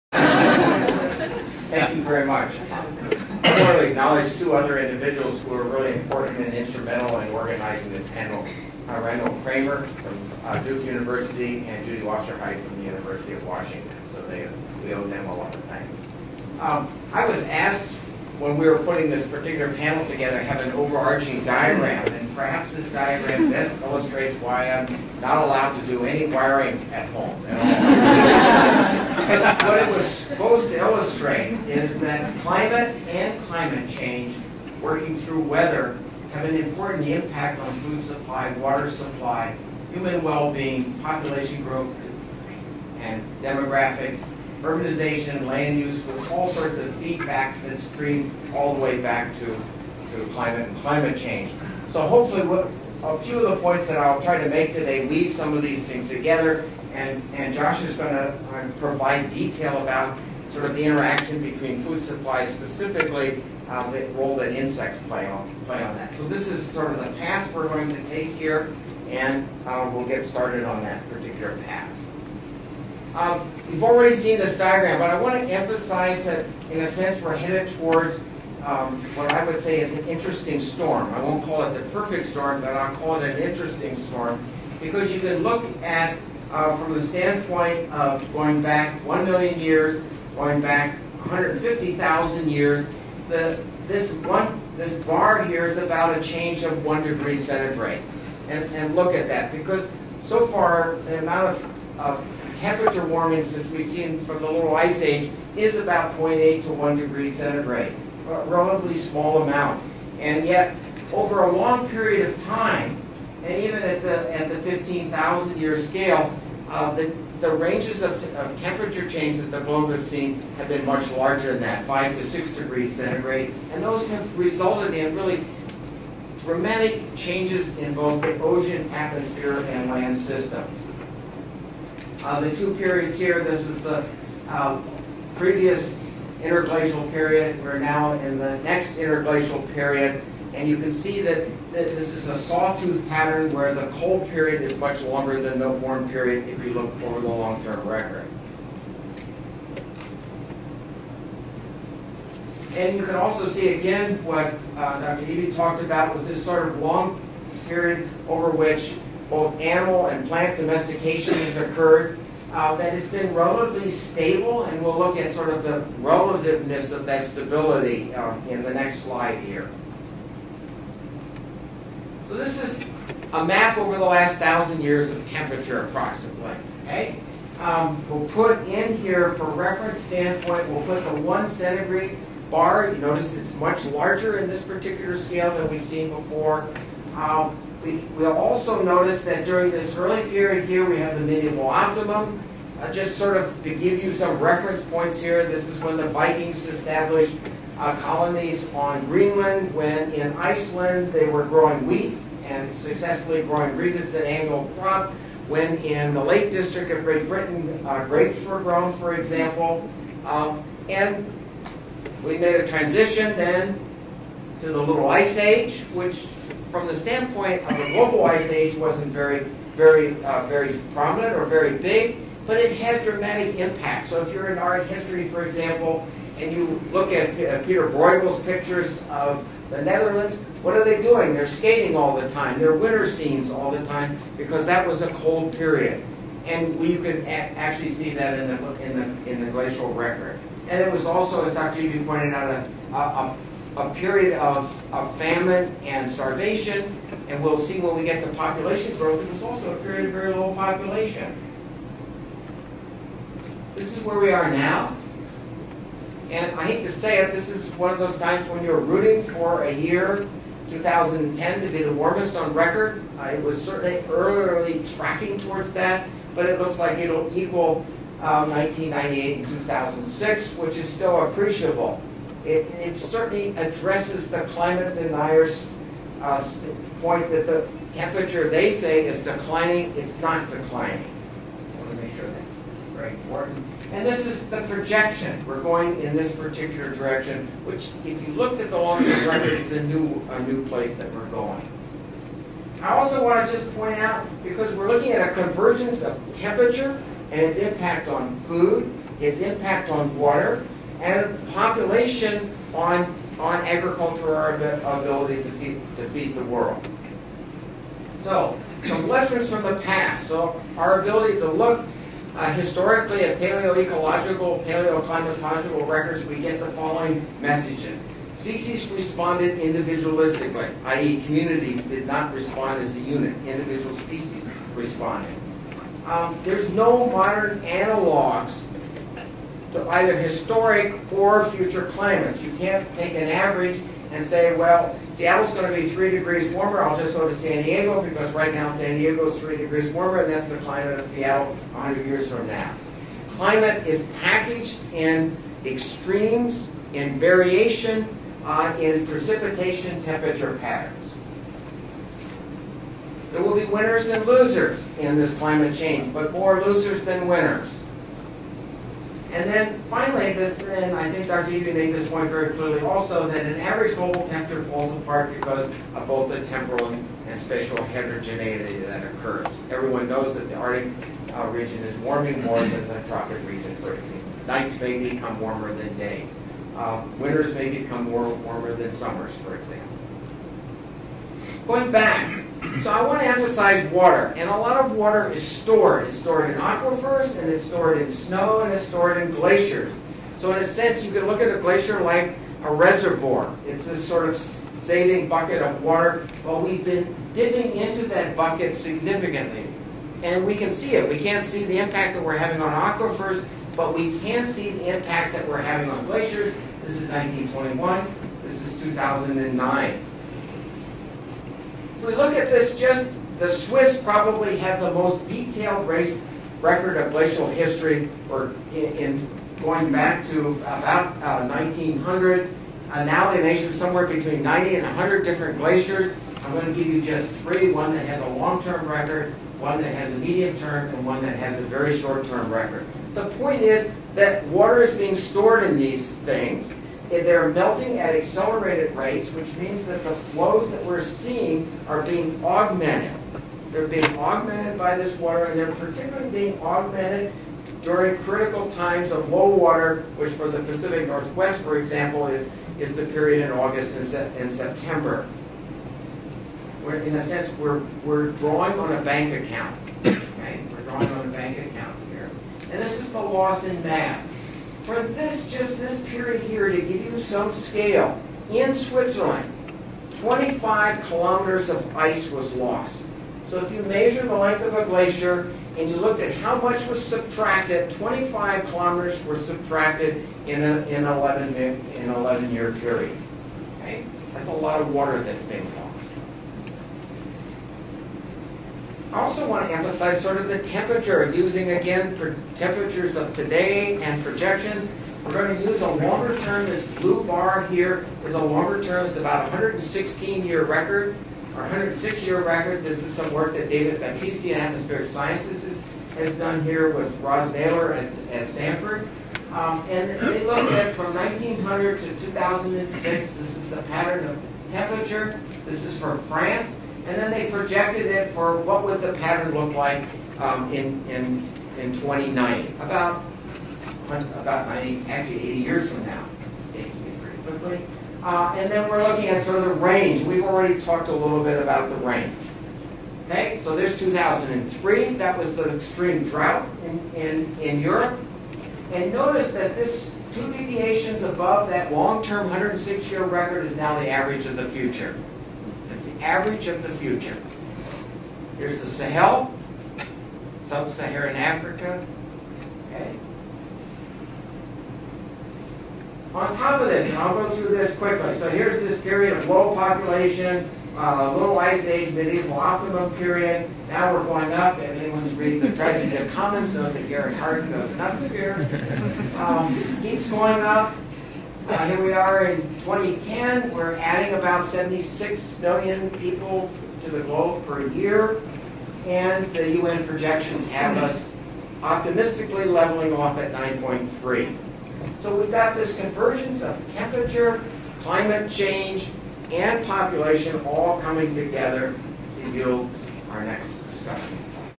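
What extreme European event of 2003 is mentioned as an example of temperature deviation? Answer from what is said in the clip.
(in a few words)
extreme drought.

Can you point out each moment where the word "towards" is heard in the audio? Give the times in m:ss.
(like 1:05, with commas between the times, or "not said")
1:17, 4:25.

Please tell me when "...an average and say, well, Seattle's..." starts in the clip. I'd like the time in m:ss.
5:33.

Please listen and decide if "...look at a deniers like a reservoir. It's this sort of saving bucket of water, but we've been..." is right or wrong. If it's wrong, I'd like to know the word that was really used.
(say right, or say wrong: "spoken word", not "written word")
wrong: "glacier", not "deniers".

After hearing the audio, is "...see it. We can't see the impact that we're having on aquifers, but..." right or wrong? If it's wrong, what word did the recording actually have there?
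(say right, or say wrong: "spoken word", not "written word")
right.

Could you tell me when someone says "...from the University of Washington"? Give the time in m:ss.
0:12.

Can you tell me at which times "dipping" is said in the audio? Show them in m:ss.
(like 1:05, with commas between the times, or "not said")
6:37.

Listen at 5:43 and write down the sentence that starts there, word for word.
Climate is packaged in extremes, in variation, uh, in precipitation temperature patterns.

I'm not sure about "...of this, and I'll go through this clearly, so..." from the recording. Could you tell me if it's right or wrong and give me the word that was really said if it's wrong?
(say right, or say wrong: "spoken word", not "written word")
wrong: "quickly", not "clearly".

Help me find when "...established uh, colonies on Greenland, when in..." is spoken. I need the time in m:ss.
3:16.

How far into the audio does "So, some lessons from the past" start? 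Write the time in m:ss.
5:08.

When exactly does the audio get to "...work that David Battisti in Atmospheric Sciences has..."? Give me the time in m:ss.
8:23.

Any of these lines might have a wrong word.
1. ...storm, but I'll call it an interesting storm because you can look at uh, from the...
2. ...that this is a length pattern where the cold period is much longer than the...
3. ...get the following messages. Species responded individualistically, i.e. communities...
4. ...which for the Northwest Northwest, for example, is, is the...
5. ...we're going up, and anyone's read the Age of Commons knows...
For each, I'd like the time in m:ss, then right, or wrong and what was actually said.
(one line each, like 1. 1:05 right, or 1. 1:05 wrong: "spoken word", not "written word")
1. 1:22 right
2. 2:21 wrong: "sawtooth", not "length"
3. 5:16 right
4. 7:30 wrong: "Pacific", not "Northwest"
5. 9:24 wrong: "Tragedy", not "Age".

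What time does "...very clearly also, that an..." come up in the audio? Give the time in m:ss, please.
6:02.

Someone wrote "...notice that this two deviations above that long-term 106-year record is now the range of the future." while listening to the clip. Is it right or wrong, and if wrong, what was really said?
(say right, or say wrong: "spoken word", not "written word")
wrong: "average", not "range".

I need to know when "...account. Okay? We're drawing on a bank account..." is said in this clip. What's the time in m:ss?
7:39.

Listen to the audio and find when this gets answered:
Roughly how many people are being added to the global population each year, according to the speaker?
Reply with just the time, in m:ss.
9:34.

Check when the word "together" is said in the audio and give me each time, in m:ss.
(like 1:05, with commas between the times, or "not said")
0:20, 0:56, 9:51.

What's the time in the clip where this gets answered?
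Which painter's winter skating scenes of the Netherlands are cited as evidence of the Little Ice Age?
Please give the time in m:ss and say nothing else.
3:47.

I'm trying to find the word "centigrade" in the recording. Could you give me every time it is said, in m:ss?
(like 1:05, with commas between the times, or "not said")
1:37, 1:47, 2:02, 3:01.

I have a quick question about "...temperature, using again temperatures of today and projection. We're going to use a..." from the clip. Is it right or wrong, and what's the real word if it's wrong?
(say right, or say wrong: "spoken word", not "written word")
right.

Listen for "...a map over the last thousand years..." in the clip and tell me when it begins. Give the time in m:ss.
2:53.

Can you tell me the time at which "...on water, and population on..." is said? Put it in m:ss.
4:59.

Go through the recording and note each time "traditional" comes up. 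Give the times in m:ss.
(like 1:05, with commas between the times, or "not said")
not said.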